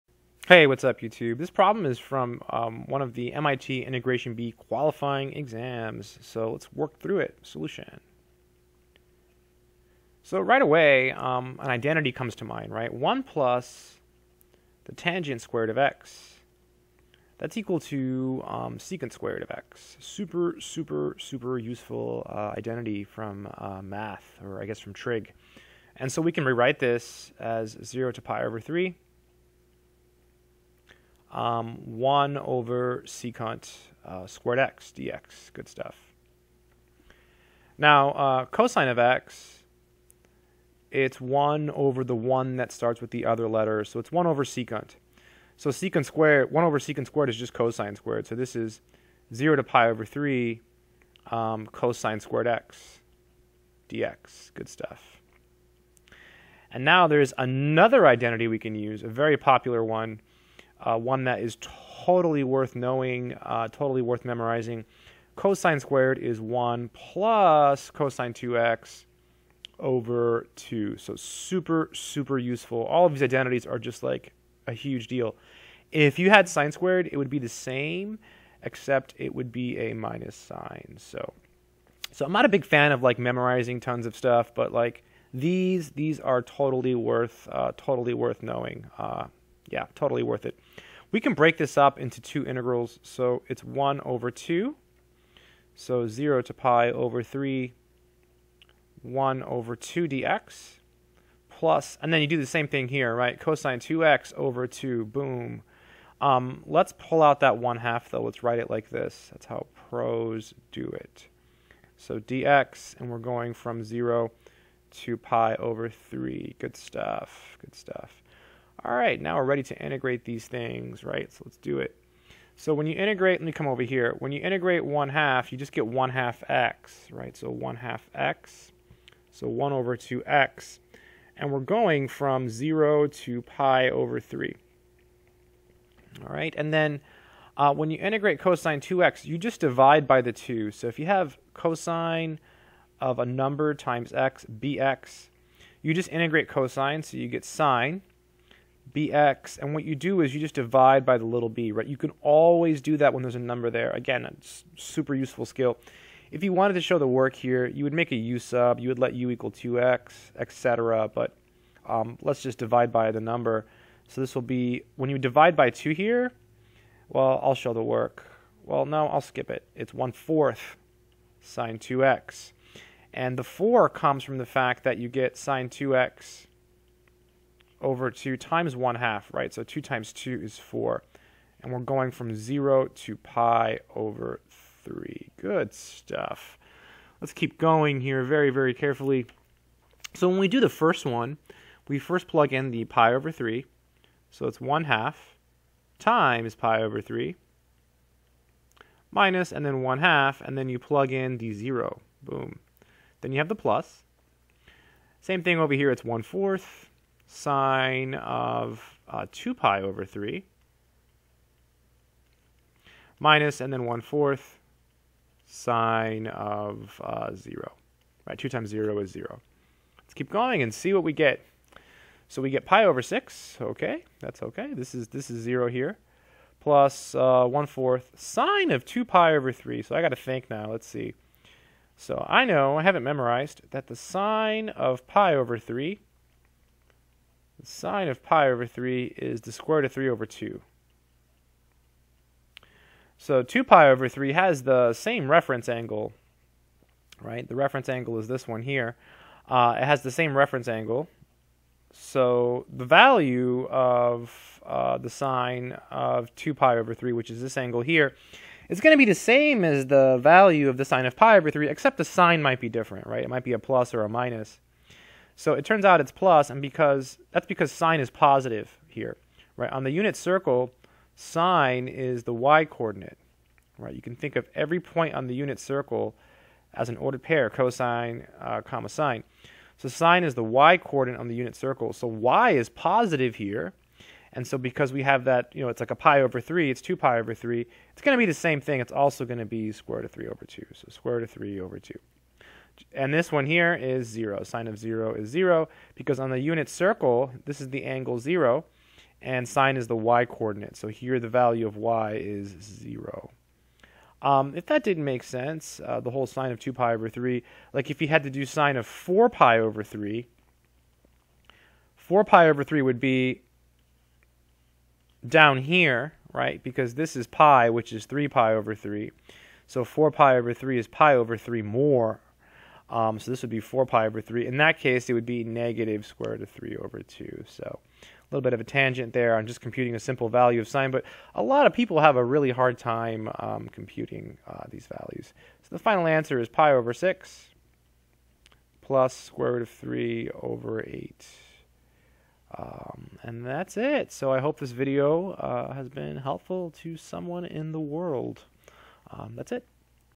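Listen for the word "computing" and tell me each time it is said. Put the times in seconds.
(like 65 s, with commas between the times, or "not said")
329 s, 333 s.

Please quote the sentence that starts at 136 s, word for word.
All right, and then uh, when you integrate cosine 2x, you just divide by the 2.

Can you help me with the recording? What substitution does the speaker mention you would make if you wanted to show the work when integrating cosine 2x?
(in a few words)
u equal 2x.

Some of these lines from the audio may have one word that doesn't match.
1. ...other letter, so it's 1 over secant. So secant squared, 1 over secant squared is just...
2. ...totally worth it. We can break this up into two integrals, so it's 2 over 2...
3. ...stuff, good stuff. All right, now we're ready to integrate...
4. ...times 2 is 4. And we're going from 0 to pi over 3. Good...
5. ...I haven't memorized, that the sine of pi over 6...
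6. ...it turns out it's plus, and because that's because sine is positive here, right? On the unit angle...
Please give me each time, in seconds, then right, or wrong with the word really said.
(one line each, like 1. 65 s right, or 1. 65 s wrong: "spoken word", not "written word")
1. 43 s right
2. 89 s wrong: "1", not "2"
3. 116 s right
4. 179 s right
5. 232 s wrong: "3", not "6"
6. 265 s wrong: "circle", not "angle".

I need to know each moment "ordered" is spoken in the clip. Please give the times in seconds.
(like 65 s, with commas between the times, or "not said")
276 s.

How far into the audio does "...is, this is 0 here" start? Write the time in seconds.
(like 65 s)
224 s.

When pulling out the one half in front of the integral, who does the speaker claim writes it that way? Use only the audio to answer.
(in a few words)
pros.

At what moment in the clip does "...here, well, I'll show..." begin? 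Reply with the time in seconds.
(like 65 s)
165 s.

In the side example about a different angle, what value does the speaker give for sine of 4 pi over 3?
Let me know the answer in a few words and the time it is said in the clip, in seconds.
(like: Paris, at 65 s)
negative square root of 3 over 2, at 325 s.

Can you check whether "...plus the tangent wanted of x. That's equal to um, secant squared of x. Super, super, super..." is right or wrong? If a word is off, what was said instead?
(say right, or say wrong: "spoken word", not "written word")
wrong: "squared", not "wanted".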